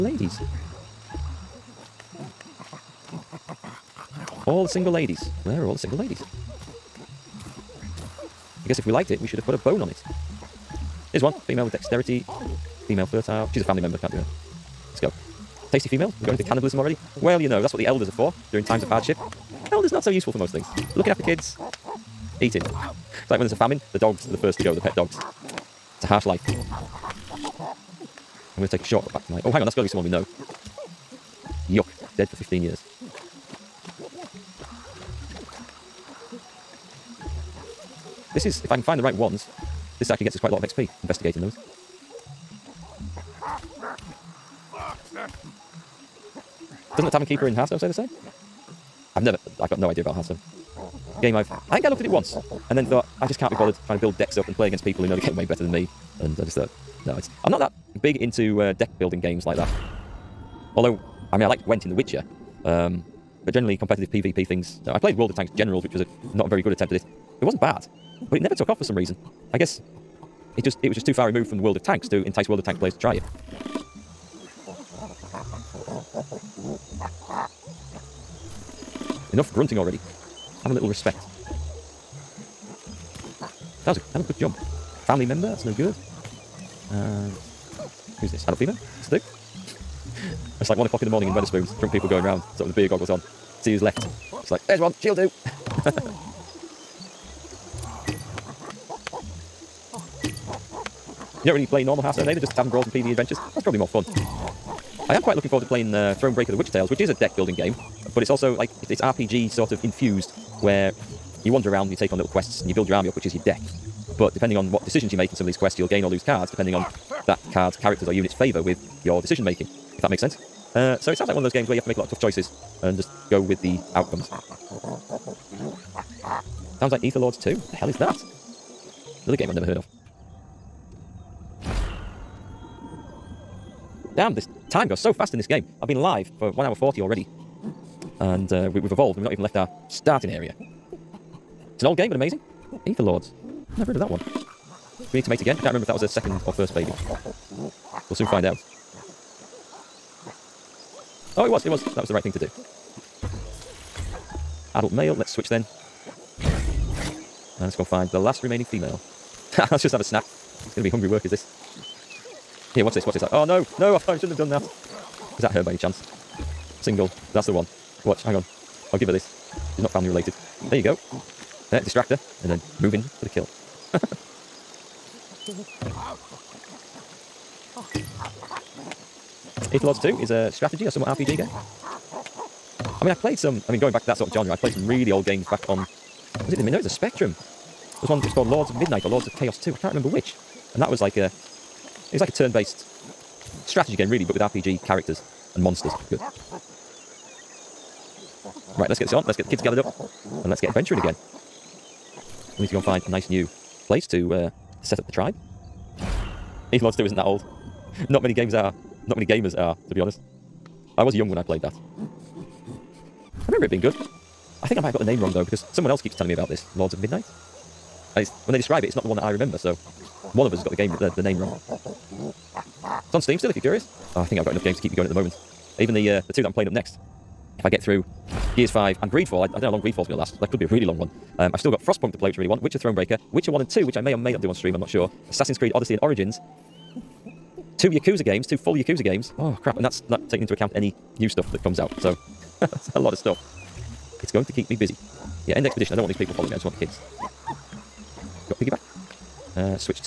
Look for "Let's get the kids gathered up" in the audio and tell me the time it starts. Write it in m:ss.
3:19.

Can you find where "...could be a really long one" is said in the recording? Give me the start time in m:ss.
3:50.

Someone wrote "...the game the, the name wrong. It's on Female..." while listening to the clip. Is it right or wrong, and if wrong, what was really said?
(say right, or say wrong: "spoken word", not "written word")
wrong: "Steam", not "Female".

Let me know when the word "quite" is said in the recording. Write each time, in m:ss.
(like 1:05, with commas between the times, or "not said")
0:40, 1:45.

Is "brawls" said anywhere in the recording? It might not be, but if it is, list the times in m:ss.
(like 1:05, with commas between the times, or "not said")
1:42.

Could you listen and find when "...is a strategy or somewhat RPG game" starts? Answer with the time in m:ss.
3:00.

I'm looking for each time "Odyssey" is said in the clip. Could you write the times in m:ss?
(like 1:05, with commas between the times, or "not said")
3:55.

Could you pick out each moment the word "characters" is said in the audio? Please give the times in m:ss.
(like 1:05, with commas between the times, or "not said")
1:57, 3:14.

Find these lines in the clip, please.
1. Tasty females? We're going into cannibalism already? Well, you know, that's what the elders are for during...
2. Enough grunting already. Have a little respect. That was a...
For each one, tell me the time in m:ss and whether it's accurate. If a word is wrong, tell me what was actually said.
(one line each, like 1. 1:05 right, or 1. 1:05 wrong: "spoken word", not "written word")
1. 0:15 right
2. 1:19 right.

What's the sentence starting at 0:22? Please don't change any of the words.
It's like when there's a famine, the dogs are the first to go, the pet dogs.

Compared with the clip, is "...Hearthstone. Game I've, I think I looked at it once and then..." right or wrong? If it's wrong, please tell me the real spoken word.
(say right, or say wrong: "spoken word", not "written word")
right.